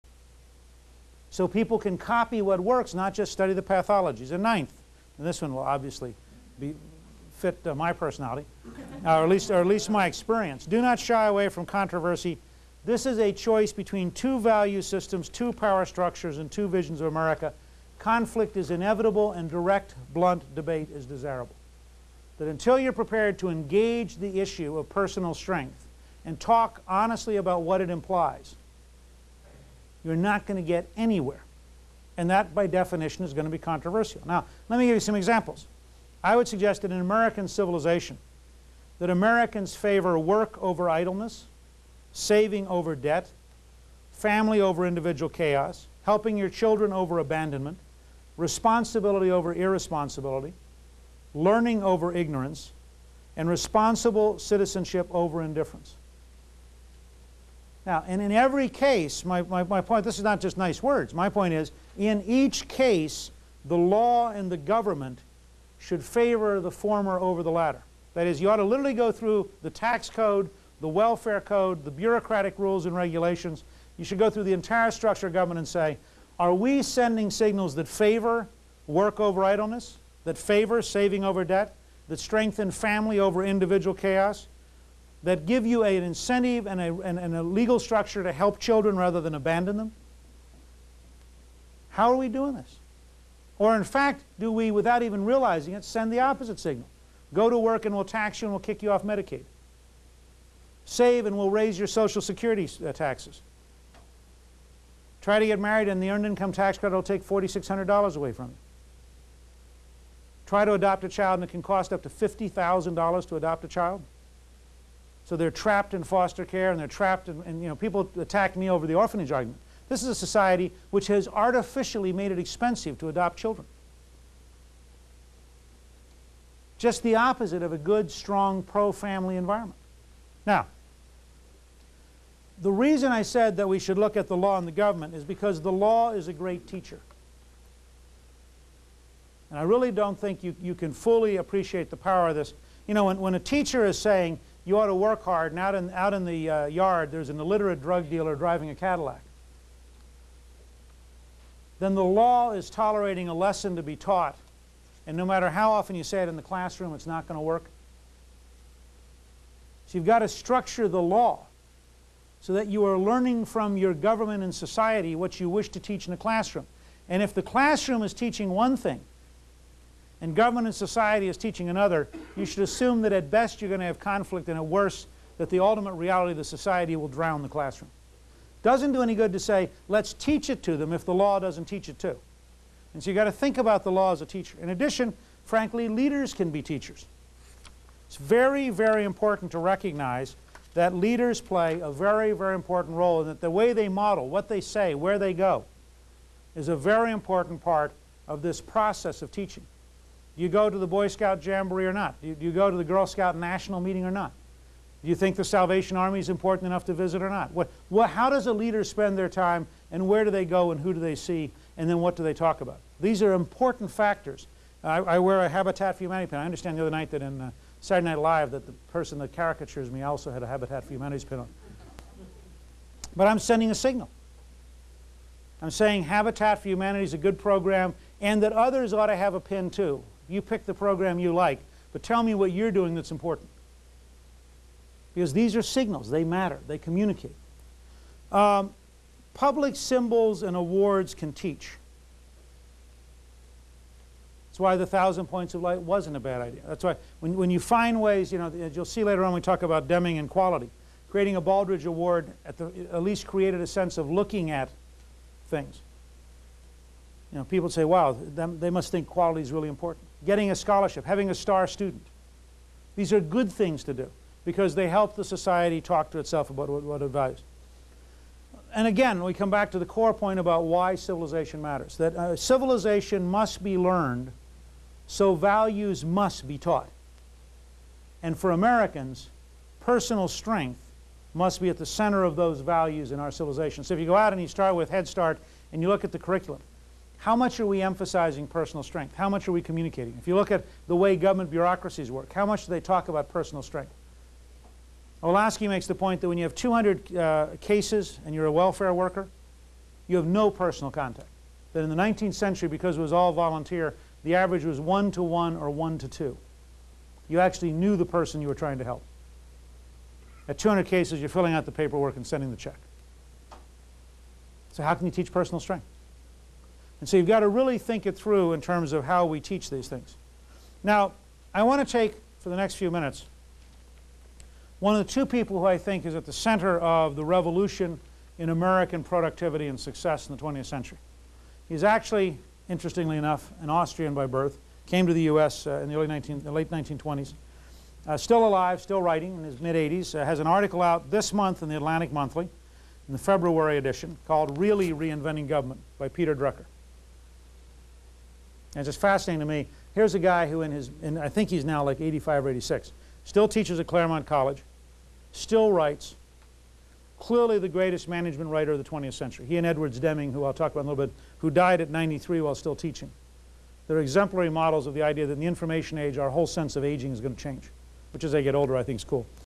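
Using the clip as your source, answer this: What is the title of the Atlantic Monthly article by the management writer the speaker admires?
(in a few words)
Really Reinventing Government.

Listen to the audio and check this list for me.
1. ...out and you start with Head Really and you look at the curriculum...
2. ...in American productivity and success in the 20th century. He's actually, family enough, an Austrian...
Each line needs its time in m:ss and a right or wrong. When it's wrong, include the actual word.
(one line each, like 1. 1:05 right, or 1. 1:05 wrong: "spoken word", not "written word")
1. 4:44 wrong: "Start", not "Really"
2. 5:28 wrong: "interestingly", not "family".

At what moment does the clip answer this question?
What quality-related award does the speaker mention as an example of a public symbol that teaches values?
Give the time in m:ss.
4:11.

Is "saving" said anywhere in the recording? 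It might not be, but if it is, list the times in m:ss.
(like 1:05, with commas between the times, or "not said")
0:42, 1:20.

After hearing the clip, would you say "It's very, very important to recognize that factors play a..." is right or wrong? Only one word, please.
wrong.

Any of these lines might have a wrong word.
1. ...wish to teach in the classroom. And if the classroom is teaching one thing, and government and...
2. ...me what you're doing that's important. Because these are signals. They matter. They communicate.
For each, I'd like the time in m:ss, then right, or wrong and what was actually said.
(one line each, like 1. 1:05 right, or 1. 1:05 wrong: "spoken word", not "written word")
1. 2:45 right
2. 3:52 right.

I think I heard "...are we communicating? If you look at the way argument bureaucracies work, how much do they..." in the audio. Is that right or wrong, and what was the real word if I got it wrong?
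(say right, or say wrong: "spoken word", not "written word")
wrong: "government", not "argument".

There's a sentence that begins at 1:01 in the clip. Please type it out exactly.
My point is, in each case, the law and the government should favor the former over the latter.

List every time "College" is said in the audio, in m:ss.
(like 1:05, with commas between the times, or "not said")
5:54.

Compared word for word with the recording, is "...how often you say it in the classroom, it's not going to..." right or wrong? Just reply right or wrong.
right.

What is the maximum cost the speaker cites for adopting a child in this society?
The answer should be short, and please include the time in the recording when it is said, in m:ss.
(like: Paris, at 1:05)
$50,000, at 1:52.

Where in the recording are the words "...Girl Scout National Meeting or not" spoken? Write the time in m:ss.
3:22.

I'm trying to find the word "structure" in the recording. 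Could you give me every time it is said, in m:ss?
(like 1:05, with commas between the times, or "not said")
0:15, 1:14, 1:27, 2:40.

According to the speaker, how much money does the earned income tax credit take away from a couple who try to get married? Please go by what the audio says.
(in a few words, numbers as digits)
$4,600.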